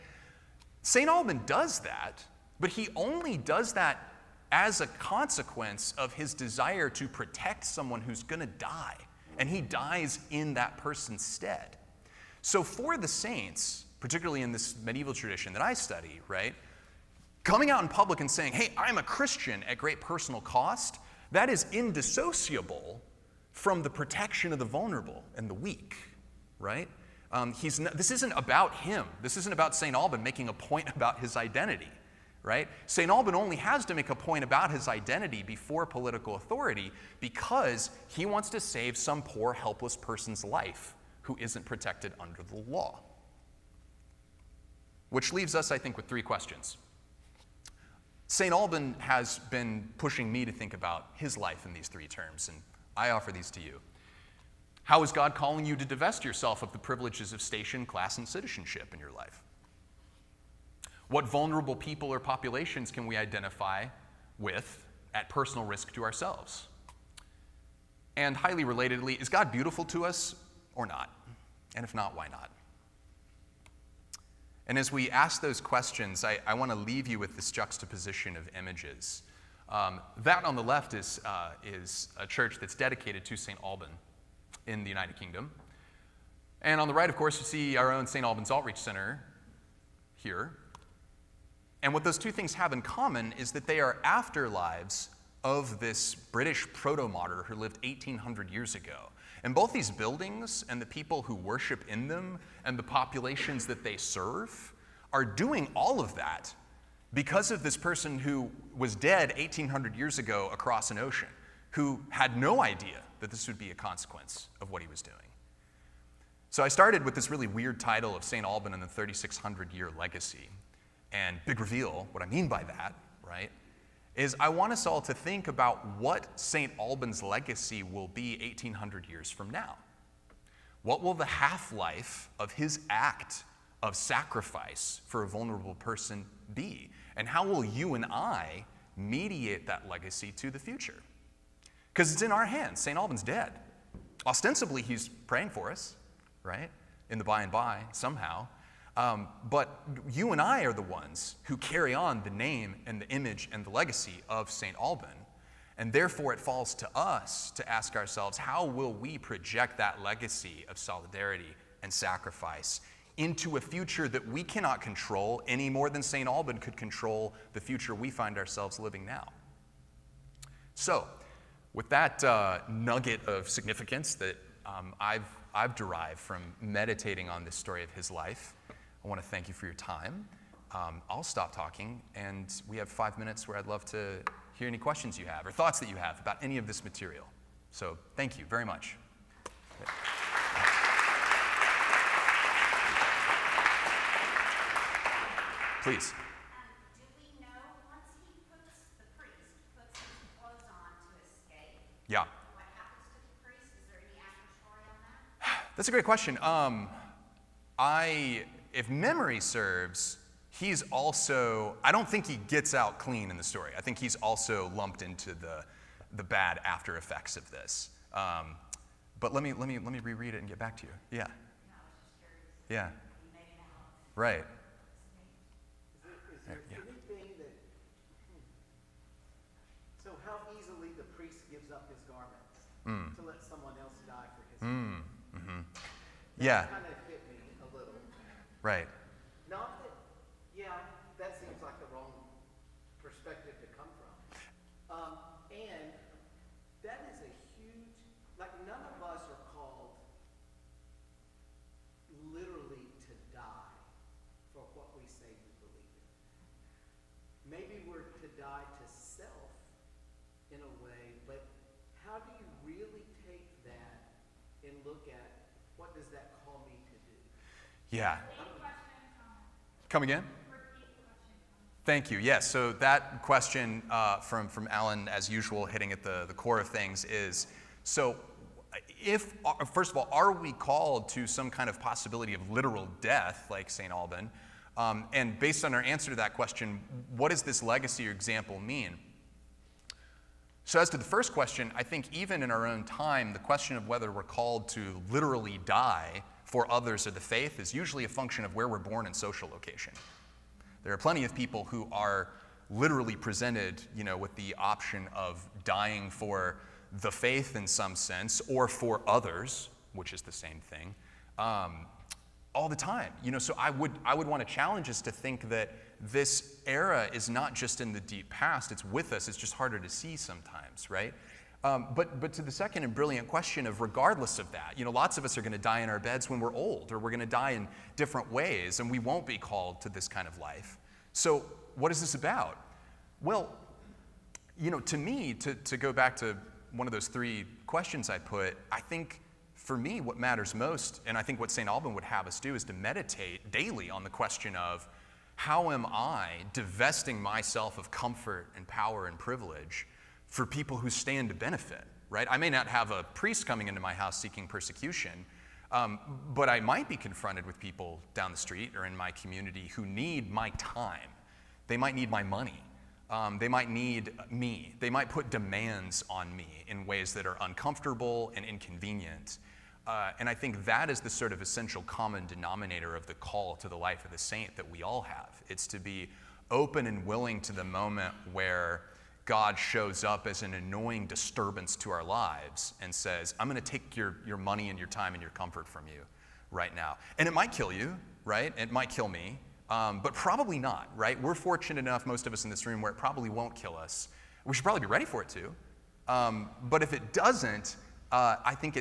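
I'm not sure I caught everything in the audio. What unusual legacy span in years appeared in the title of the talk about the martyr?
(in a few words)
3600.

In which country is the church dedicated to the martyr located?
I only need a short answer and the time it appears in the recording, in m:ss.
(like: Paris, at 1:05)
United Kingdom, at 1:24.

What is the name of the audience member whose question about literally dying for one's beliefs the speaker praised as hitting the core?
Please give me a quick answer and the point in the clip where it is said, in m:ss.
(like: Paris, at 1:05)
Alan, at 4:34.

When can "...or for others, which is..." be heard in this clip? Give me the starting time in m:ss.
5:08.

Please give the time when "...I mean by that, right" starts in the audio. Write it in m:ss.
2:02.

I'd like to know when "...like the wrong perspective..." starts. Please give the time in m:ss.
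4:01.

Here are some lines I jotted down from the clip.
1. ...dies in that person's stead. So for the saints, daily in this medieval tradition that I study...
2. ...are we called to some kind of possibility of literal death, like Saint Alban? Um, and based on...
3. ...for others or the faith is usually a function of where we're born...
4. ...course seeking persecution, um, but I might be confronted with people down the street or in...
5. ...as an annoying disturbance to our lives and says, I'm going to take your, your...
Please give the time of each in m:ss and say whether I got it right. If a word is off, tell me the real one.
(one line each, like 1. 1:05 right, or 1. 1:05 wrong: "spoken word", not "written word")
1. 0:09 wrong: "particularly", not "daily"
2. 4:40 right
3. 4:56 right
4. 5:53 wrong: "house", not "course"
5. 6:20 right.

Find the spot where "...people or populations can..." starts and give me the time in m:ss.
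1:01.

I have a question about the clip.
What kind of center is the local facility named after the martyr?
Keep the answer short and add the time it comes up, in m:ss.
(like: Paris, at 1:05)
Outreach Center, at 1:28.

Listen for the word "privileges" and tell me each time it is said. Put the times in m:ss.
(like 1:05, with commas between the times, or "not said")
0:56, 5:49.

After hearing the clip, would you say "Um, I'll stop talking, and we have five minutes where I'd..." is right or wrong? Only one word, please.
right.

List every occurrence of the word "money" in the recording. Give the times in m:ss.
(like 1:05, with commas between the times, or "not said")
6:02, 6:24.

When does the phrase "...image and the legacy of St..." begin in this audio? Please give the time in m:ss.
2:33.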